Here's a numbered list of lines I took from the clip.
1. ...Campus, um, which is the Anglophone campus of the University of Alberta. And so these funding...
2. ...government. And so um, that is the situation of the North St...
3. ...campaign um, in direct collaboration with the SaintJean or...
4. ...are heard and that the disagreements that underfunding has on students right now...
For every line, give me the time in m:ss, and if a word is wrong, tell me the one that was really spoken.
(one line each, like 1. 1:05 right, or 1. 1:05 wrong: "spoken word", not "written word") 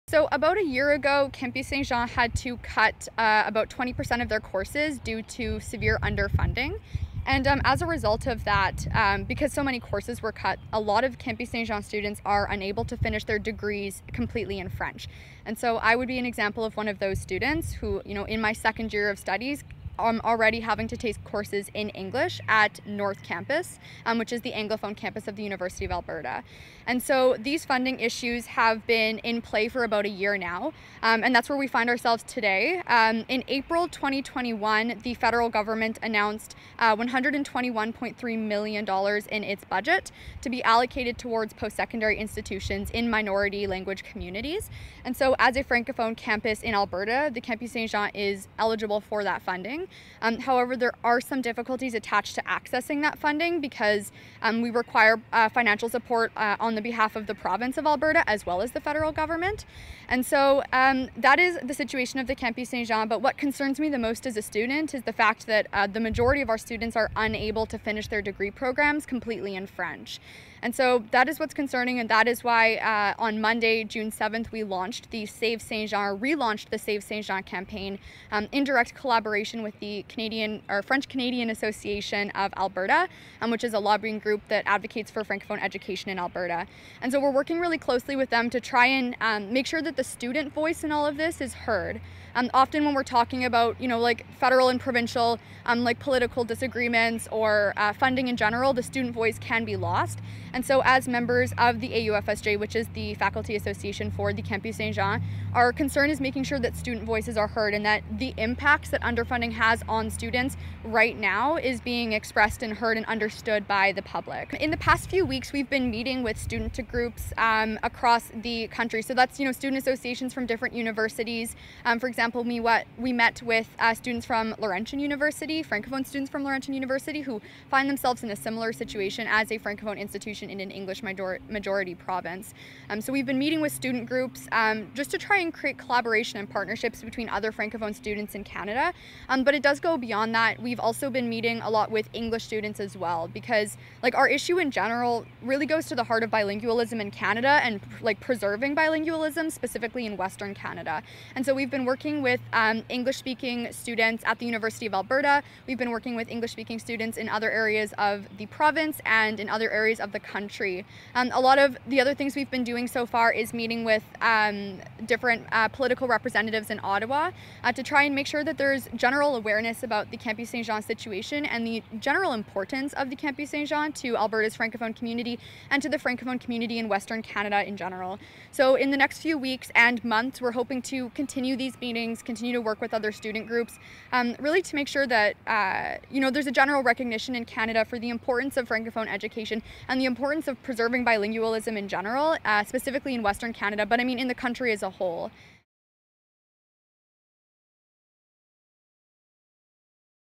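1. 0:23 right
2. 0:59 wrong: "Campus", not "North"
3. 1:17 wrong: "Canadian", not "SaintJean"
4. 1:47 wrong: "impacts", not "disagreements".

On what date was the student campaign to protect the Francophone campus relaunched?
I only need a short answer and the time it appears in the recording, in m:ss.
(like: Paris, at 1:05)
Monday, June 7th, at 1:13.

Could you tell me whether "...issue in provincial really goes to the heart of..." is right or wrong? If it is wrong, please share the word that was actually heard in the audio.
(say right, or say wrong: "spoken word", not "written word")
wrong: "general", not "provincial".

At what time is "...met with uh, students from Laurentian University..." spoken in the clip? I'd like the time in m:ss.
2:03.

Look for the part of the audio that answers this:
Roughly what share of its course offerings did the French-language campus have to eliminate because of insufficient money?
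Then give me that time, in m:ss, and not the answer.
0:03.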